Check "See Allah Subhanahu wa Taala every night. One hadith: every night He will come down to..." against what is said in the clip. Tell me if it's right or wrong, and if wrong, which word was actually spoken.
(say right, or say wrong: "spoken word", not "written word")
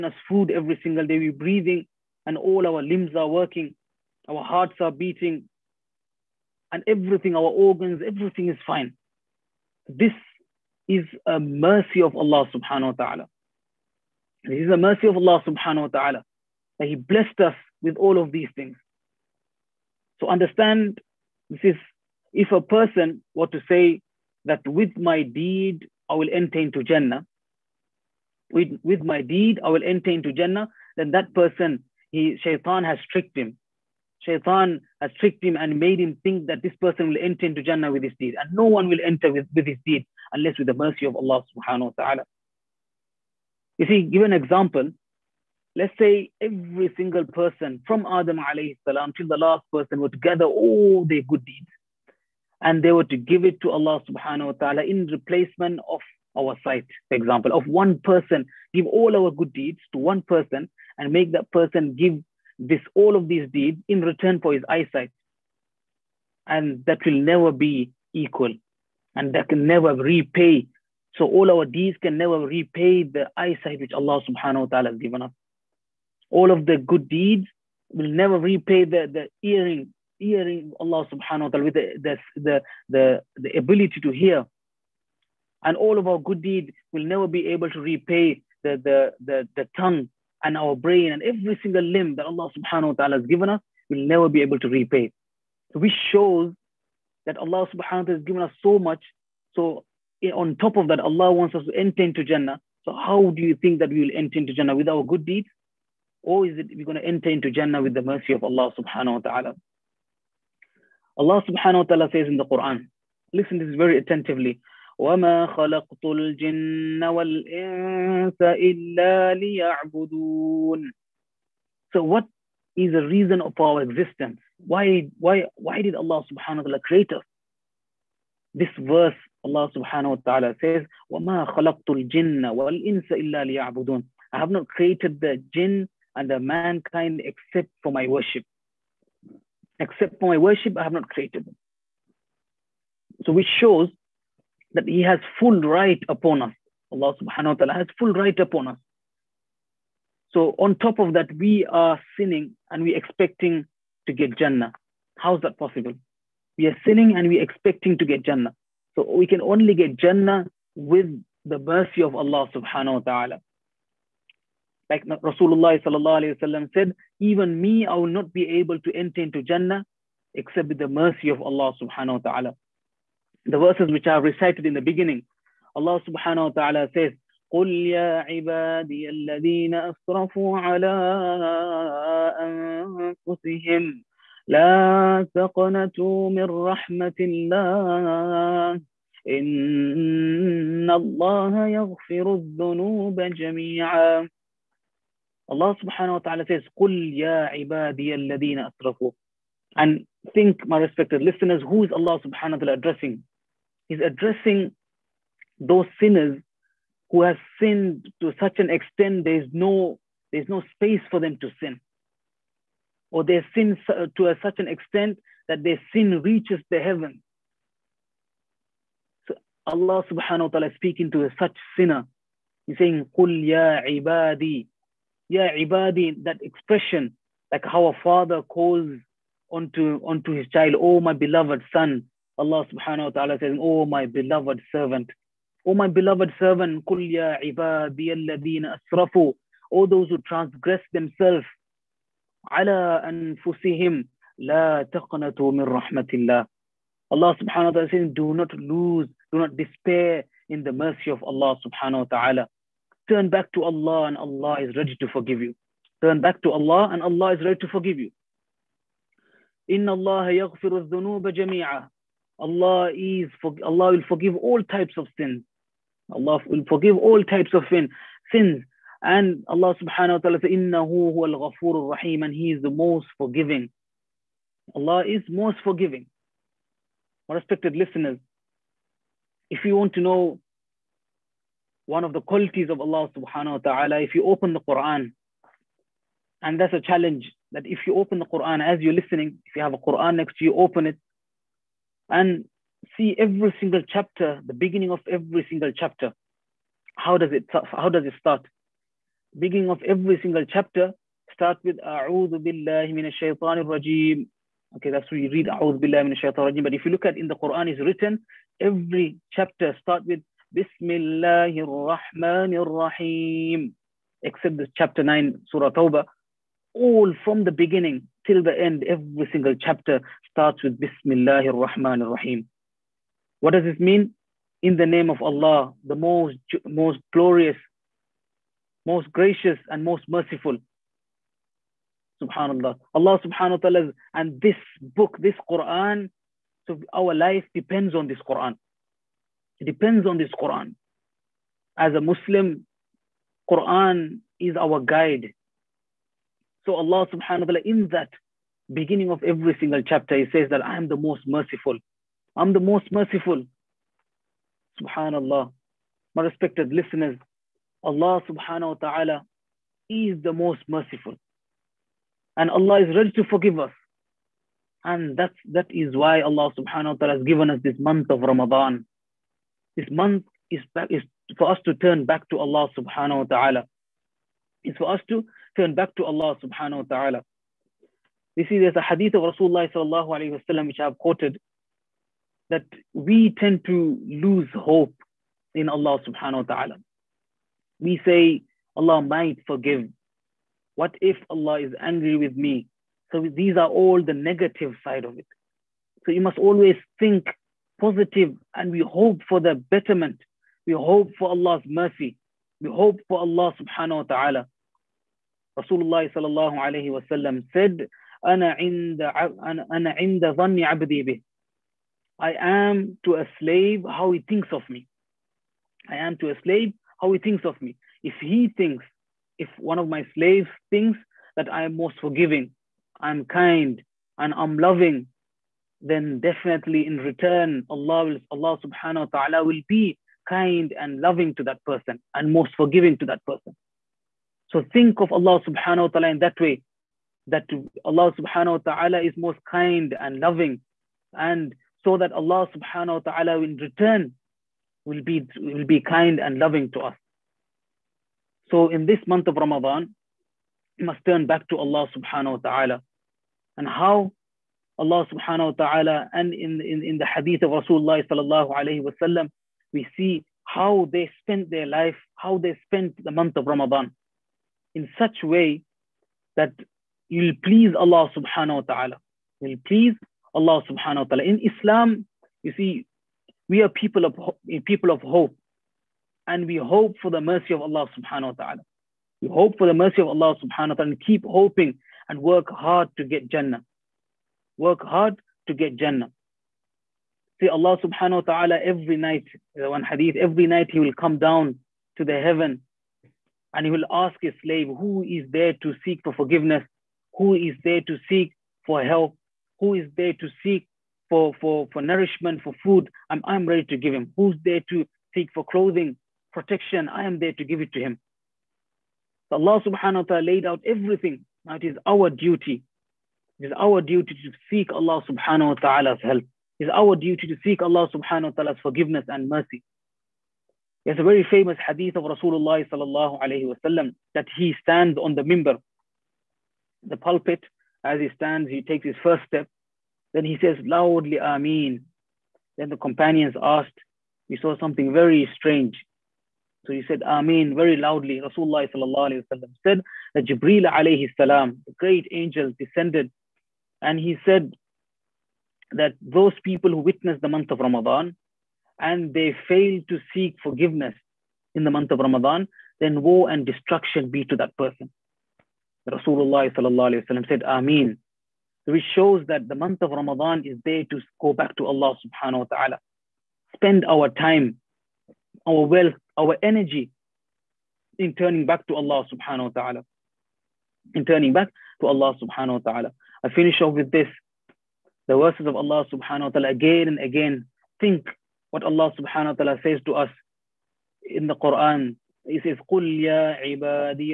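right.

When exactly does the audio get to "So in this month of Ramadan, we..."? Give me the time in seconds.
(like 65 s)
448 s.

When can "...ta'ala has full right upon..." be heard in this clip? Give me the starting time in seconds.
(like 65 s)
147 s.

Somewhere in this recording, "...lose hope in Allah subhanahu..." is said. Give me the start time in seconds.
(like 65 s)
384 s.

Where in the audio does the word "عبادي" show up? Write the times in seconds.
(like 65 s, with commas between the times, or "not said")
178 s, 197 s, 583 s.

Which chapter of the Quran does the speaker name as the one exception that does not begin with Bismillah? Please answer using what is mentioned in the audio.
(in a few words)
Surah Tawbah.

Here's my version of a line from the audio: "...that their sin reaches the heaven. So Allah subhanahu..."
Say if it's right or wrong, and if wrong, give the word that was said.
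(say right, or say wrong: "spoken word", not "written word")
right.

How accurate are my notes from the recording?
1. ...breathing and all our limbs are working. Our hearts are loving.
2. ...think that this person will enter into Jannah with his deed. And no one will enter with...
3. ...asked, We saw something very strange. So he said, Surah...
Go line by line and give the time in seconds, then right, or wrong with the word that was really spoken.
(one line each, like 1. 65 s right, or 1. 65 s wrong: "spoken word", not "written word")
1. 1 s wrong: "beating", not "loving"
2. 36 s right
3. 533 s wrong: "Ameen", not "Surah".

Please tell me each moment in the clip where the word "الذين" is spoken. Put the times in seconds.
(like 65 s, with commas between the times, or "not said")
179 s, 198 s.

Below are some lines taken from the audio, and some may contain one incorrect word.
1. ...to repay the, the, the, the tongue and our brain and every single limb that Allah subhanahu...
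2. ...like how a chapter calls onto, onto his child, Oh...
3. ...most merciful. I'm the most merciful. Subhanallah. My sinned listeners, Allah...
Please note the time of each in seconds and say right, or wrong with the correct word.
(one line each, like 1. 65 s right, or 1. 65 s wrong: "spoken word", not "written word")
1. 87 s right
2. 227 s wrong: "father", not "chapter"
3. 350 s wrong: "respected", not "sinned".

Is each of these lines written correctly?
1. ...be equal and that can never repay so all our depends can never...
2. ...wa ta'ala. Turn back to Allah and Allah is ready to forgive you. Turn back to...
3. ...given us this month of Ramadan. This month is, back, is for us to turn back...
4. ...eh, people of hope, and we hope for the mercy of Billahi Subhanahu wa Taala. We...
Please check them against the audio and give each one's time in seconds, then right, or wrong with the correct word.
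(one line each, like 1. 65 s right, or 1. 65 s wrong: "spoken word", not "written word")
1. 67 s wrong: "deeds", not "depends"
2. 252 s right
3. 367 s right
4. 474 s wrong: "Allah", not "Billahi".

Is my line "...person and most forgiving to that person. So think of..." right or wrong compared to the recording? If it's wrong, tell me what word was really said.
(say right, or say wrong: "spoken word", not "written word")
right.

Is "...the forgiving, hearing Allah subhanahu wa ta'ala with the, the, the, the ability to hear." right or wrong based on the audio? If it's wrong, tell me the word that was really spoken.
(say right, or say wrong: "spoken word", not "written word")
wrong: "hearing", not "forgiving".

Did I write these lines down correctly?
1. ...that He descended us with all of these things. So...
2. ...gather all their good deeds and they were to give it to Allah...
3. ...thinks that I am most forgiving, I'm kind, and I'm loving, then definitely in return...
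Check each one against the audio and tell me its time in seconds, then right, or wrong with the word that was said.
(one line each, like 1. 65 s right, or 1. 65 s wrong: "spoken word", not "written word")
1. 16 s wrong: "blessed", not "descended"
2. 50 s right
3. 420 s right.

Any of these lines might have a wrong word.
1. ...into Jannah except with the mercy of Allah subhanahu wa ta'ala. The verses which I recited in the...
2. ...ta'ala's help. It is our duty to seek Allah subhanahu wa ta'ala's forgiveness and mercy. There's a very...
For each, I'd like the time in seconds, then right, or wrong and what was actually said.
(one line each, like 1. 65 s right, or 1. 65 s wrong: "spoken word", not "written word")
1. 169 s right
2. 515 s right.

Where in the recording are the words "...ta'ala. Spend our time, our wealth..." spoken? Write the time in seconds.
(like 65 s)
562 s.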